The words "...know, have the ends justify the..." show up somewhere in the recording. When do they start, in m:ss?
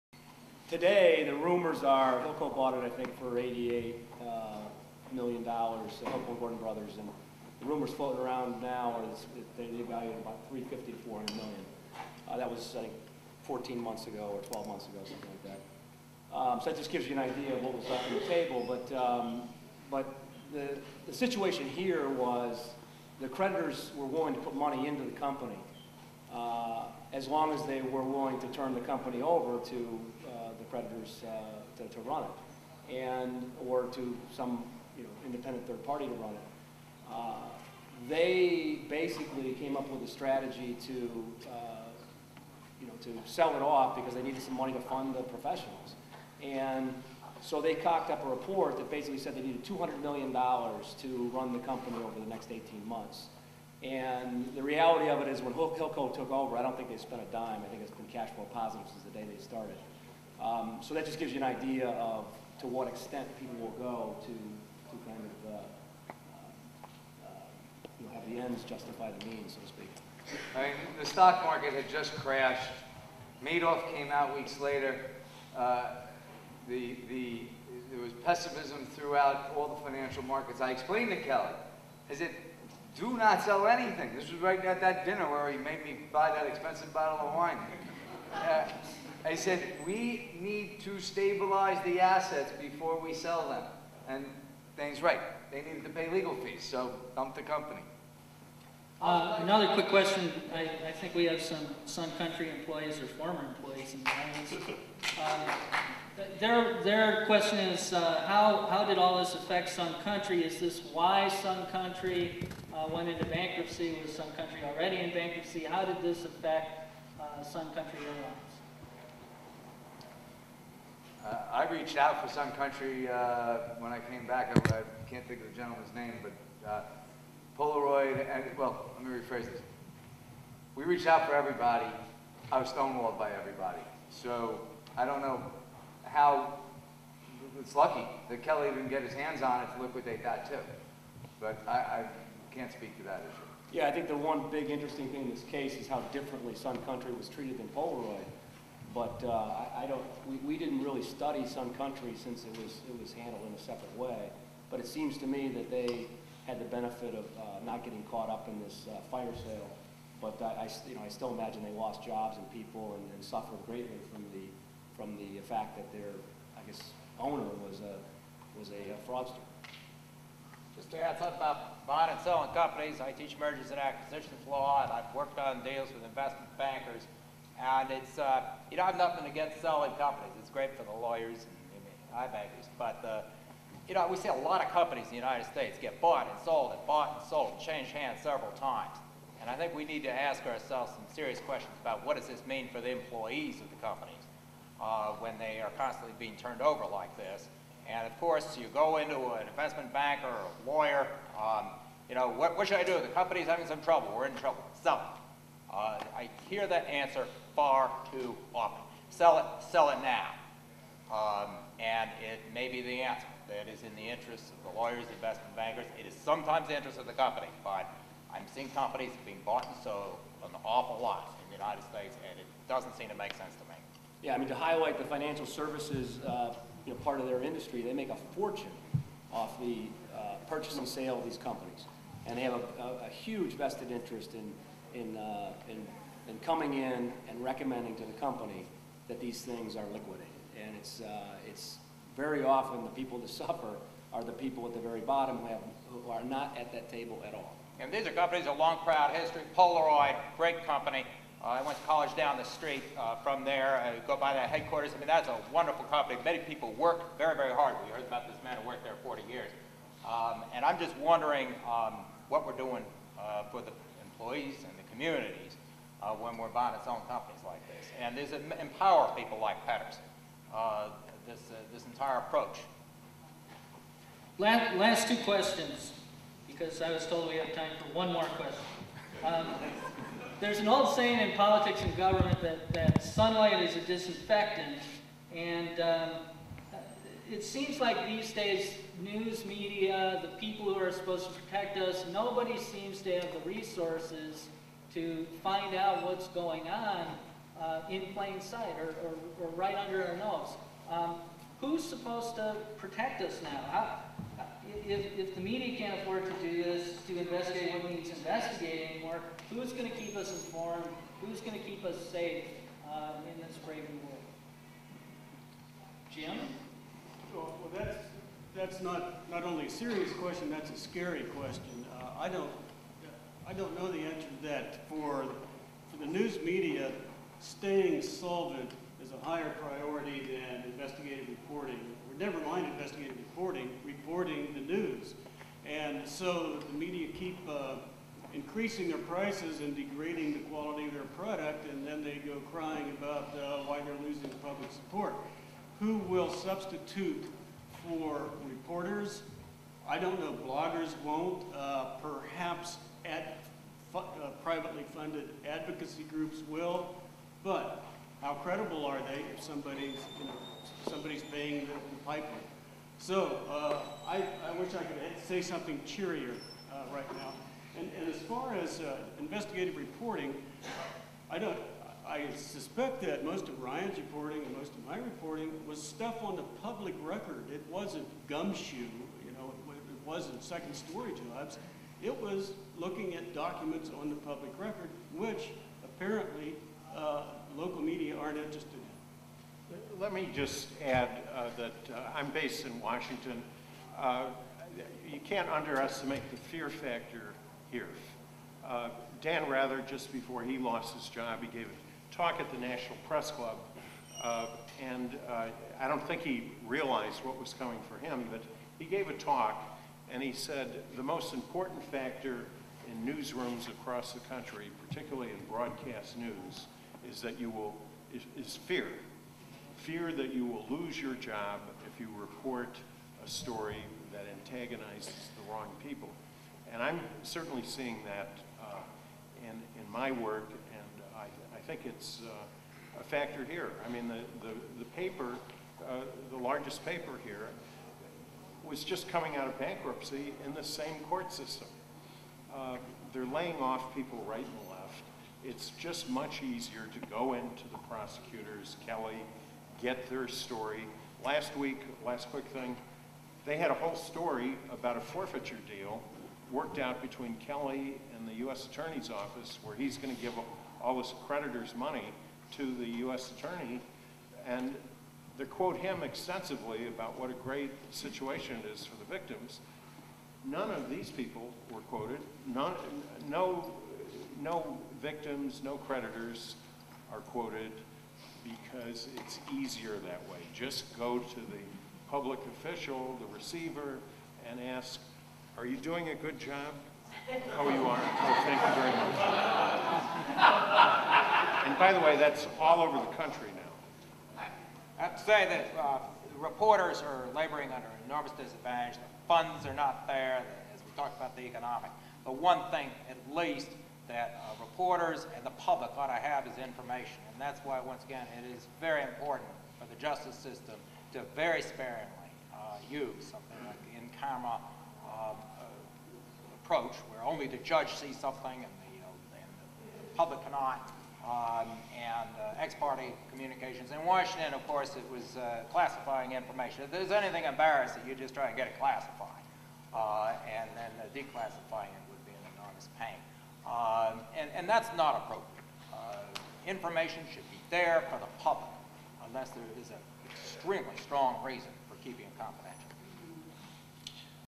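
1:08.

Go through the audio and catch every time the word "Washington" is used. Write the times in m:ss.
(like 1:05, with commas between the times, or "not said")
6:32, 8:44.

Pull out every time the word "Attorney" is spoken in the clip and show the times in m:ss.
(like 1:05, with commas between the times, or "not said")
7:38, 7:43.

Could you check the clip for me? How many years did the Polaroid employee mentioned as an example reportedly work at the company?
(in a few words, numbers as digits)
40 years.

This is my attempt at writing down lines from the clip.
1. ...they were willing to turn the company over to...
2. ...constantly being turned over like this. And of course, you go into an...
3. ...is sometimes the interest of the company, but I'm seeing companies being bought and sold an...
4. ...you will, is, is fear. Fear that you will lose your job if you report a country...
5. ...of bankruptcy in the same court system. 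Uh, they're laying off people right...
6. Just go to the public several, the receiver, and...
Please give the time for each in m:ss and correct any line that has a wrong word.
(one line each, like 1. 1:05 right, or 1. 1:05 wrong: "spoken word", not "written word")
1. 0:27 right
2. 3:15 right
3. 3:36 right
4. 6:57 wrong: "story", not "country"
5. 7:19 right
6. 8:00 wrong: "official", not "several".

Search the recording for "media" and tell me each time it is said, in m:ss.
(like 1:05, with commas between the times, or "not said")
4:49, 5:05, 5:26, 5:36, 6:27.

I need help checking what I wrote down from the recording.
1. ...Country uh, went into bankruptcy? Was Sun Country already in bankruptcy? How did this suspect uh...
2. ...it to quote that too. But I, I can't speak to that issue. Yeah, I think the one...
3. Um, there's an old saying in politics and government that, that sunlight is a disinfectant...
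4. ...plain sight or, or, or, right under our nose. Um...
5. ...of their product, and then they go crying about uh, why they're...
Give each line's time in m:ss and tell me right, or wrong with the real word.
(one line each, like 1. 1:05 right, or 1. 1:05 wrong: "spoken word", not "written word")
1. 1:51 wrong: "affect", not "suspect"
2. 2:19 wrong: "liquidate", not "quote"
3. 4:39 right
4. 4:58 right
5. 5:40 right.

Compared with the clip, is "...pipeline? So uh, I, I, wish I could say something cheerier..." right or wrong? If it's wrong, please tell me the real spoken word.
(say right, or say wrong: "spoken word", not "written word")
right.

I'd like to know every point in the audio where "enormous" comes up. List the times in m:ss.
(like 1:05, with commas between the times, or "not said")
8:18, 8:52.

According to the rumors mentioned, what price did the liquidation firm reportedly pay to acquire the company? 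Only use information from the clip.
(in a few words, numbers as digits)
$88 million.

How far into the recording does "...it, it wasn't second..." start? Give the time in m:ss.
6:19.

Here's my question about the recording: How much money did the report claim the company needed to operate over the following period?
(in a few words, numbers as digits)
$200 million.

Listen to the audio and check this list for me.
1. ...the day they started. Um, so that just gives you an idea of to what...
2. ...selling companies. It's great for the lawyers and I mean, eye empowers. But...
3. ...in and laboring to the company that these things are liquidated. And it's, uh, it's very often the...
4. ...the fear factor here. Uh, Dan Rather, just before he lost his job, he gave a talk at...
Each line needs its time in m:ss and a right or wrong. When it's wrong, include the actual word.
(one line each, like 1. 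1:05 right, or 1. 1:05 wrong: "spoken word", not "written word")
1. 0:59 right
2. 2:59 wrong: "bankers", not "empowers"
3. 3:56 wrong: "recommending", not "laboring"
4. 6:36 right.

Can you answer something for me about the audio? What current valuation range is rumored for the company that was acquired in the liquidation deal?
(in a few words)
350 to 400 million.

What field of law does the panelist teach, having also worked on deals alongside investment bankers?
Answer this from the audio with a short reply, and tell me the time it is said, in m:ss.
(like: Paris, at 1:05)
Mergers and acquisitions law, at 2:53.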